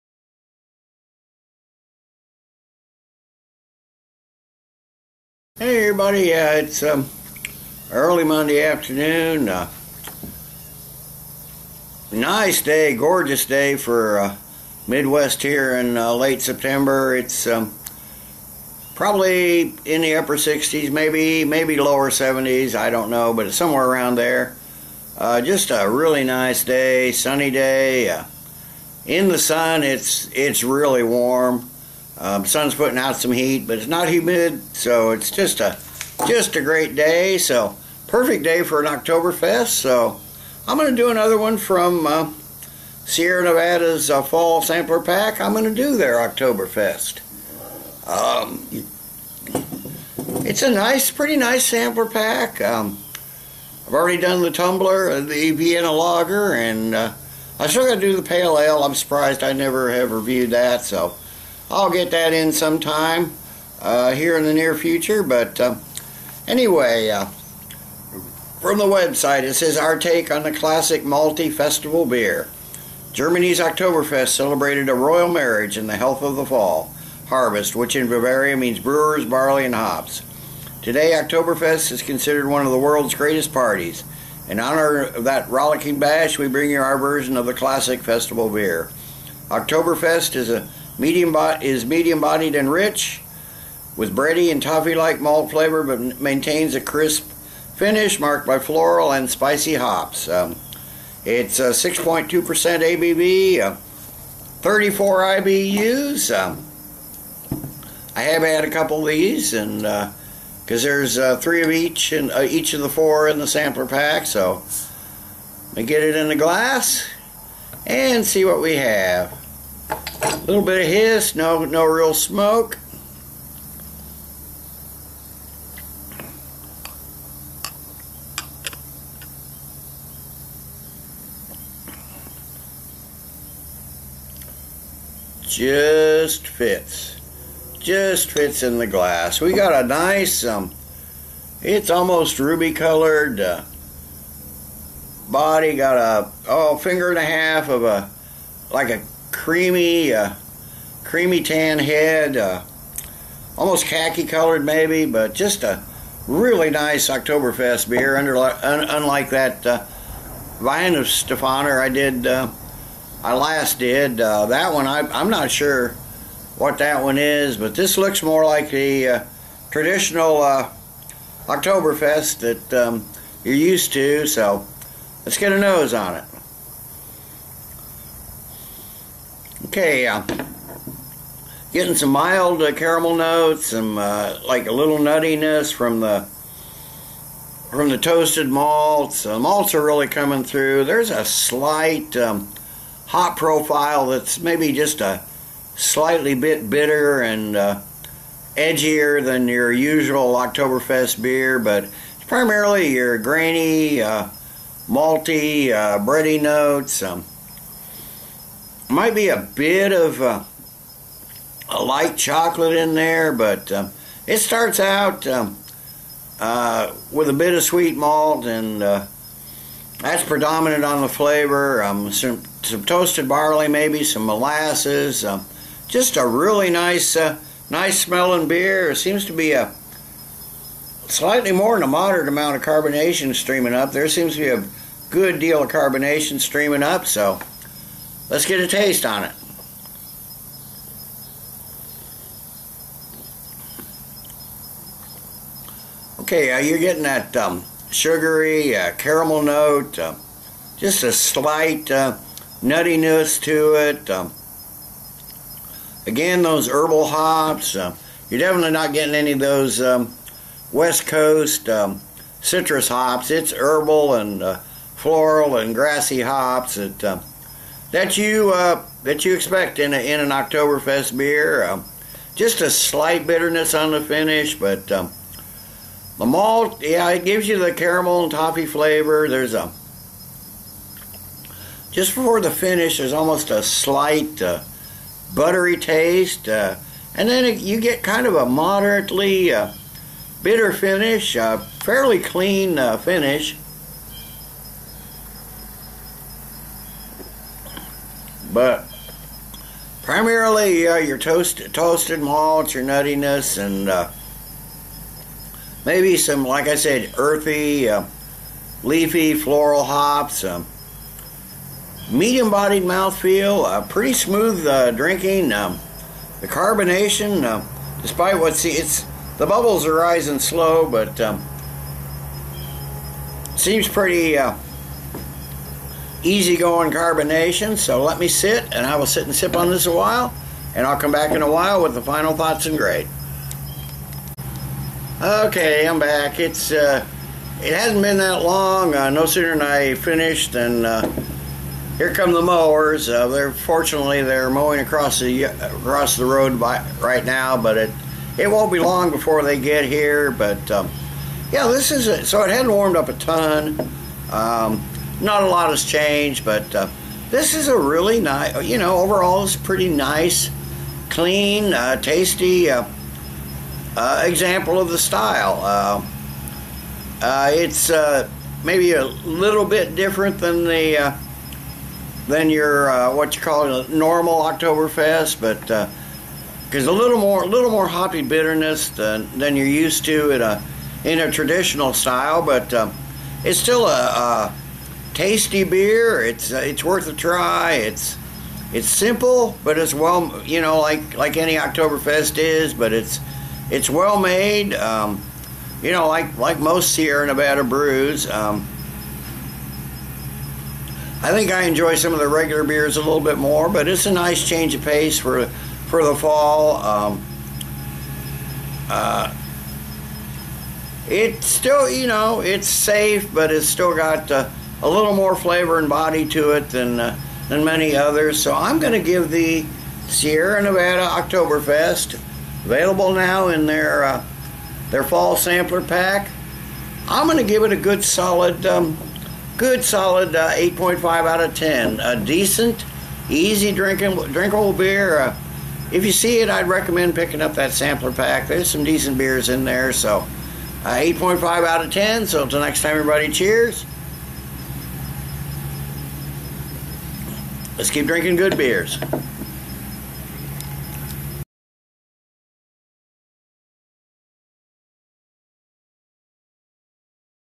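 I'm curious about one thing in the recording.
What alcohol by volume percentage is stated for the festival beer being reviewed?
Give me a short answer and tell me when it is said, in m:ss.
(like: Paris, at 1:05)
6.2%, at 1:41.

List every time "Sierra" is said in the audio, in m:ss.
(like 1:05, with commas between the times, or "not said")
0:43, 6:36, 7:00.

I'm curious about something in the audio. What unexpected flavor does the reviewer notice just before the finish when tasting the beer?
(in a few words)
Buttery.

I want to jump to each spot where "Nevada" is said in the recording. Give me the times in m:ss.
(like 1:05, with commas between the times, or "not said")
0:43, 6:37, 7:00.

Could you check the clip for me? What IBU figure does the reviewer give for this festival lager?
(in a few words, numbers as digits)
34.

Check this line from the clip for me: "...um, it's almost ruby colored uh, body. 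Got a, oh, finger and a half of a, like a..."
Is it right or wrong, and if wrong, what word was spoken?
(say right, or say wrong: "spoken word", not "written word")
right.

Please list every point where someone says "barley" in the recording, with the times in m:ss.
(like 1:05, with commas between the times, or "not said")
1:19, 3:43.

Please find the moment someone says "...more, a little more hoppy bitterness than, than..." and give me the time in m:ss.
6:17.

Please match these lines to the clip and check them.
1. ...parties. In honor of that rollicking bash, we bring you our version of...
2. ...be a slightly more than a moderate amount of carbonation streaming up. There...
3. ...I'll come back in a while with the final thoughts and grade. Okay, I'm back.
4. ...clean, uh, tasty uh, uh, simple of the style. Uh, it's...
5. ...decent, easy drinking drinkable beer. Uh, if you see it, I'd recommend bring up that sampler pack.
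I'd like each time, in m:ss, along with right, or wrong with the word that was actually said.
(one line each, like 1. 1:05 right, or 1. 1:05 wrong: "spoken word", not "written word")
1. 1:23 right
2. 3:49 right
3. 5:30 right
4. 6:01 wrong: "example", not "simple"
5. 7:12 wrong: "picking", not "bring".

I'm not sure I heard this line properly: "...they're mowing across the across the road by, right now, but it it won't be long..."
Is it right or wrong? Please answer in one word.
right.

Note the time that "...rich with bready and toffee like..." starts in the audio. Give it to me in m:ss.
1:32.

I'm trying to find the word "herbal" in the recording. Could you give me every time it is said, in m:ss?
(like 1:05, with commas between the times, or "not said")
4:16, 4:23.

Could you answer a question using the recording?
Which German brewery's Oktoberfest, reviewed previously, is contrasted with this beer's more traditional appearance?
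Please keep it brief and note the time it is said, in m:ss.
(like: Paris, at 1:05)
Weihenstephaner, at 2:40.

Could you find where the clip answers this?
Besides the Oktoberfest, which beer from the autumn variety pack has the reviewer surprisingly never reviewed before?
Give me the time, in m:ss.
0:58.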